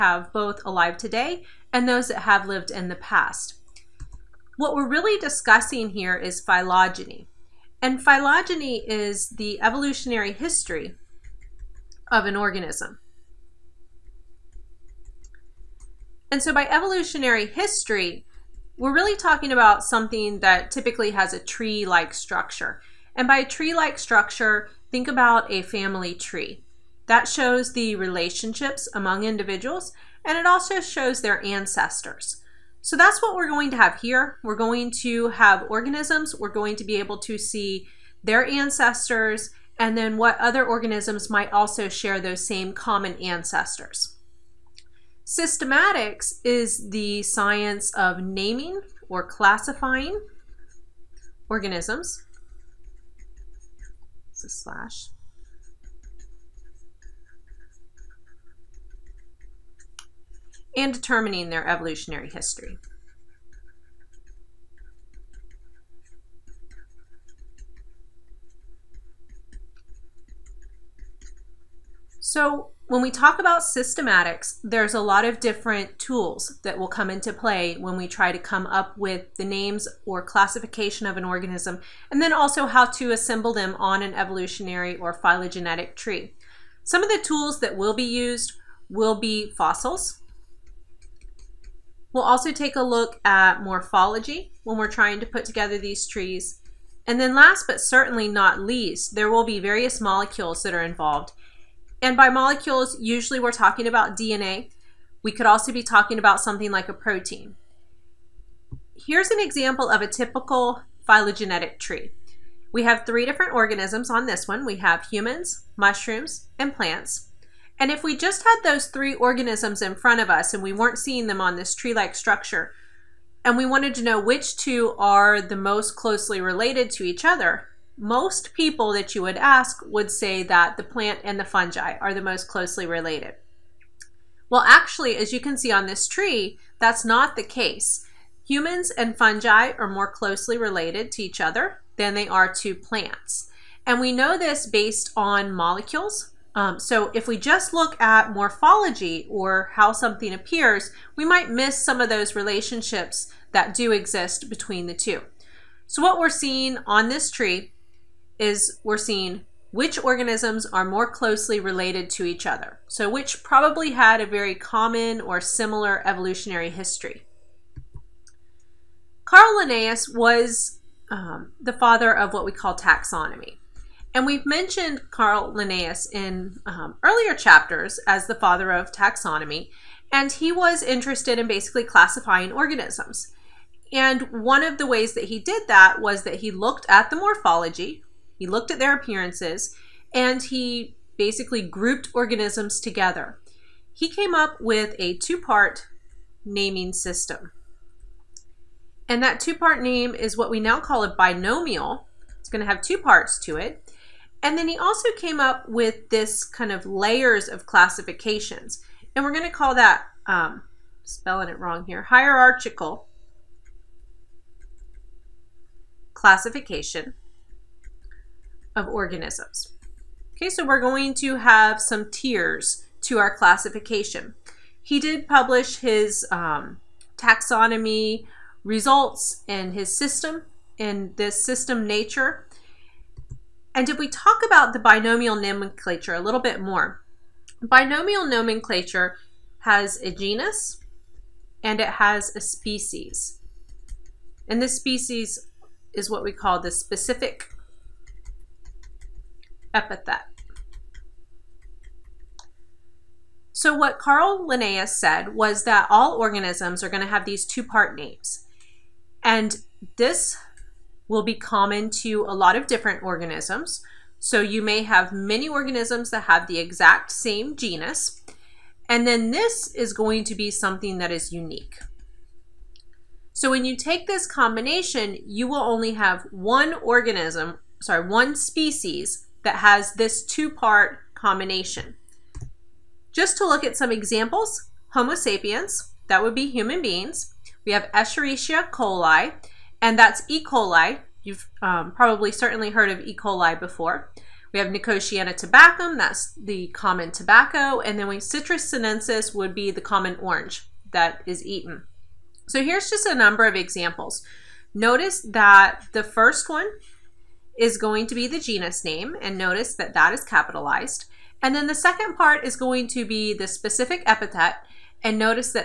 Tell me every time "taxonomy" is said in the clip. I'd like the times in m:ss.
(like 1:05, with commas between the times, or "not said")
2:52, 2:58, 3:47.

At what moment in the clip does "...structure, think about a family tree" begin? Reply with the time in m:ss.
0:23.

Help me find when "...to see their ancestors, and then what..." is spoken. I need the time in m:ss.
0:37.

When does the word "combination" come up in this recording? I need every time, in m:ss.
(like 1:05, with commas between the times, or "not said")
4:34, 4:41.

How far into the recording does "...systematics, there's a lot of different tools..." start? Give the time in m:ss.
1:13.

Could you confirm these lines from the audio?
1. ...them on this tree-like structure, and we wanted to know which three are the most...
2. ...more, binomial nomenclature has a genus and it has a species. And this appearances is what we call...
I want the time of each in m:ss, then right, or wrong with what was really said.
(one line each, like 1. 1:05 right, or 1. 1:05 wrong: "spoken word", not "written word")
1. 2:01 wrong: "two", not "three"
2. 3:56 wrong: "species", not "appearances".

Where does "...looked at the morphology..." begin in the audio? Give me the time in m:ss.
3:06.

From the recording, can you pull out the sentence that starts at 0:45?
Systematics is the science of naming or classifying organisms.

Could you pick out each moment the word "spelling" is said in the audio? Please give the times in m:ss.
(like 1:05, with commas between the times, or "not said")
3:31.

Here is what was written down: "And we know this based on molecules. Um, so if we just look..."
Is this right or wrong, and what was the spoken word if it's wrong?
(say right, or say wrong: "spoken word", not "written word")
right.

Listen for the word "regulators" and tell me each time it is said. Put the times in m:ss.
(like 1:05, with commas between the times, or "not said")
not said.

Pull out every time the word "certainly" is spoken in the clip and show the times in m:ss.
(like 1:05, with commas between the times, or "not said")
1:37, 4:52.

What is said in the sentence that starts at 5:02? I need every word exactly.
So here's just a number of examples.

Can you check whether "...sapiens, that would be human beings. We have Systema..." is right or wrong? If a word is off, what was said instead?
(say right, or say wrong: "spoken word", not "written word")
wrong: "Escherichia", not "Systema".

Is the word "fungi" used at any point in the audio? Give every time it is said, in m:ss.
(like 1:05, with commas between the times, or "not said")
2:11, 2:19.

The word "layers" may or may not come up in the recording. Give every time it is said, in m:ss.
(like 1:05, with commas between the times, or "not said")
3:26.